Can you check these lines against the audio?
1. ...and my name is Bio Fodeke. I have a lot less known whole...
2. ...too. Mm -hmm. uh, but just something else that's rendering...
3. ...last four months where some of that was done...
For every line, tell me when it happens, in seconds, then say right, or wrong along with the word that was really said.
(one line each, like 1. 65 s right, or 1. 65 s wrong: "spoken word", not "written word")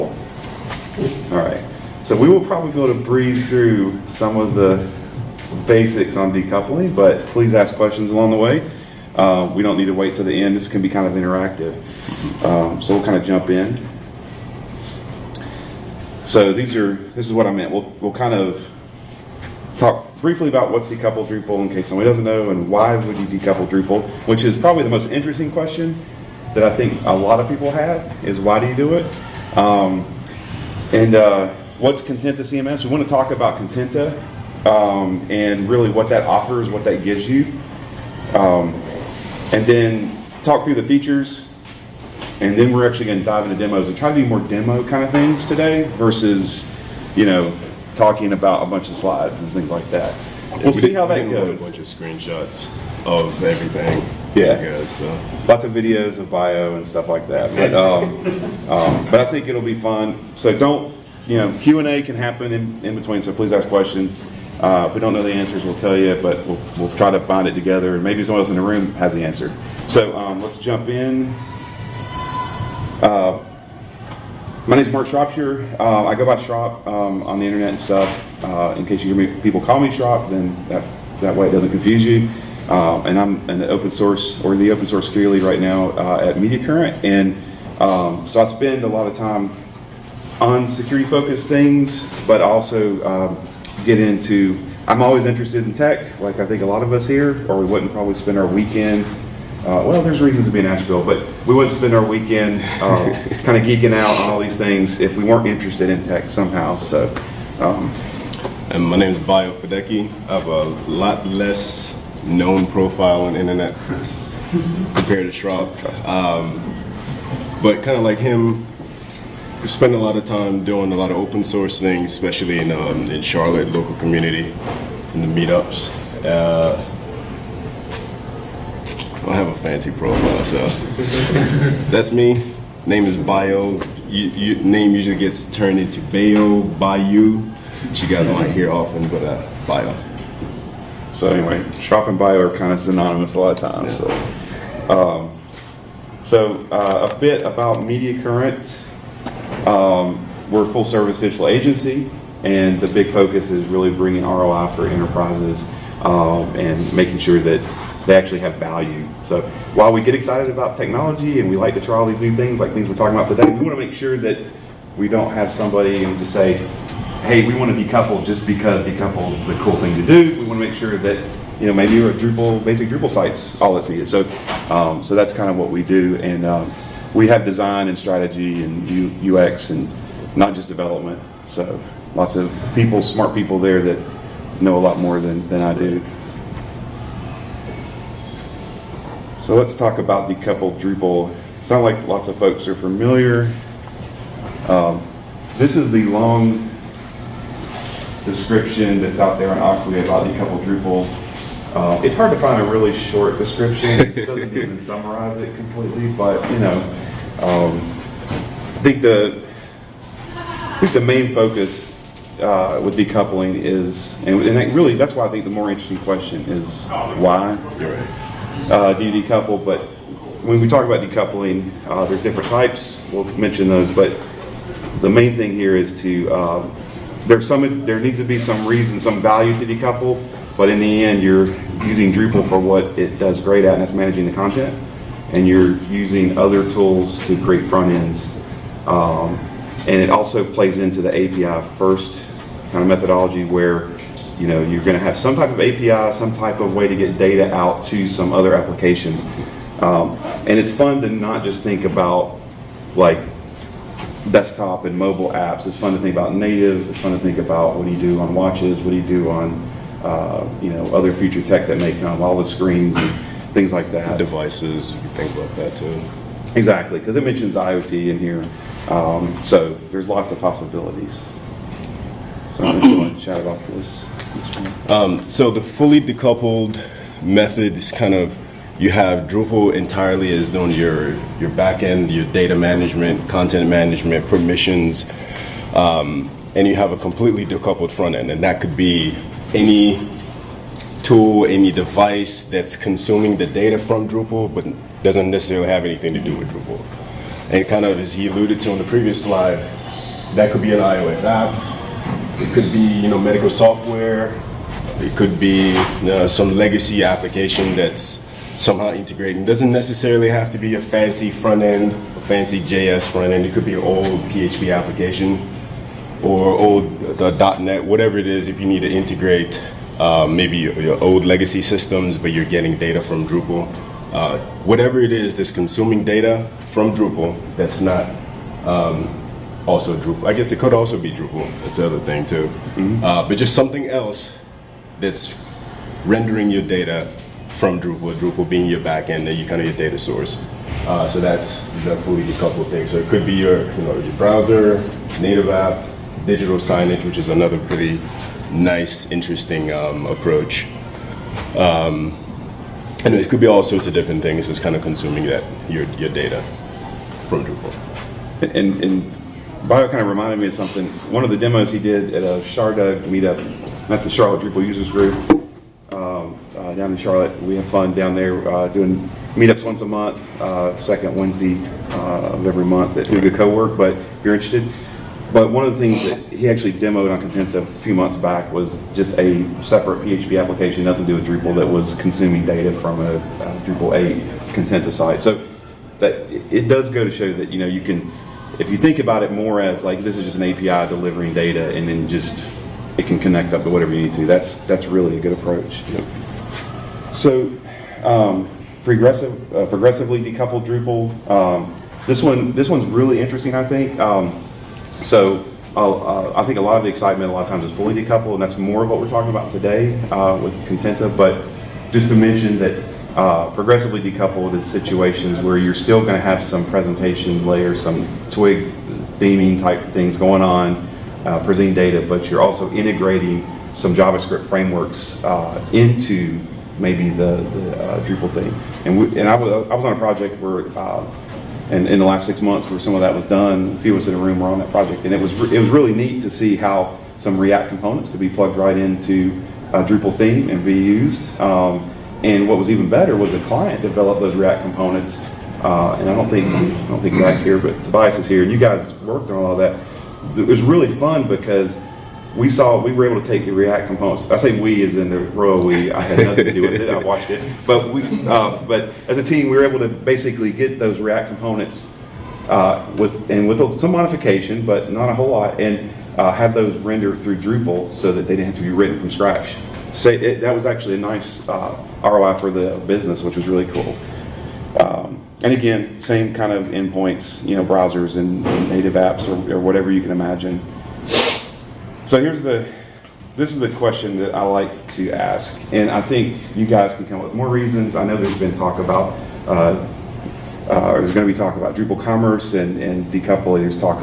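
1. 108 s wrong: "profile", not "whole"
2. 332 s right
3. 432 s wrong: "six", not "four".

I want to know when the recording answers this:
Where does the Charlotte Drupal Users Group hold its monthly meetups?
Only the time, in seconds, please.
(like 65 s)
373 s.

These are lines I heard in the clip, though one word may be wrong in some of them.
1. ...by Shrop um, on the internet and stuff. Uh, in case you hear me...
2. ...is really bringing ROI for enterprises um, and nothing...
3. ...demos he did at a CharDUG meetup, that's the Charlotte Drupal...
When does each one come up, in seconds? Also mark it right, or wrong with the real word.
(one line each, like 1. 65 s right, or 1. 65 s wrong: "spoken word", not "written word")
1. 76 s right
2. 153 s wrong: "making", not "nothing"
3. 361 s right.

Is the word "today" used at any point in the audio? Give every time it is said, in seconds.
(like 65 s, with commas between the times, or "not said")
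45 s, 163 s, 409 s.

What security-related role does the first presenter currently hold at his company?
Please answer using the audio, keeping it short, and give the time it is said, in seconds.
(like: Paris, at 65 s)
open source security lead, at 84 s.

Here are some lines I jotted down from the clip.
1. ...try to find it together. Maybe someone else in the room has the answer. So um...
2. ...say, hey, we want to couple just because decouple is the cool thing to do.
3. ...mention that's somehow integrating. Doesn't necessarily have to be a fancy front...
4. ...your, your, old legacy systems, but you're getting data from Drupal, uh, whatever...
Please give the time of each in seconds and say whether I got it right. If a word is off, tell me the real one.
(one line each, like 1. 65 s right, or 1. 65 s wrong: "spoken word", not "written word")
1. 66 s right
2. 166 s wrong: "decouple", not "couple"
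3. 307 s wrong: "application", not "mention"
4. 320 s right.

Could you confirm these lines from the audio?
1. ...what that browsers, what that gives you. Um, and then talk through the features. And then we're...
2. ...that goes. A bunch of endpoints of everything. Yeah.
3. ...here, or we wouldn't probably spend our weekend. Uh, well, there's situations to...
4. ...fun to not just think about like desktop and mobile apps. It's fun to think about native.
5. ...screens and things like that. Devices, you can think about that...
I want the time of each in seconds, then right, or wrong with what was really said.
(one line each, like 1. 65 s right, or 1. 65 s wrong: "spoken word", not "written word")
1. 35 s wrong: "offers", not "browsers"
2. 51 s wrong: "screenshots", not "endpoints"
3. 97 s wrong: "reasons", not "situations"
4. 250 s right
5. 262 s right.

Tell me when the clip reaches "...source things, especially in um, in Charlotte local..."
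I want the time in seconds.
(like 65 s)
121 s.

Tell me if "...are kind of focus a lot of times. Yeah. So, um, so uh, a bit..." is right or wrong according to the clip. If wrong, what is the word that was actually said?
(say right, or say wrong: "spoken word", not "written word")
wrong: "synonymous", not "focus".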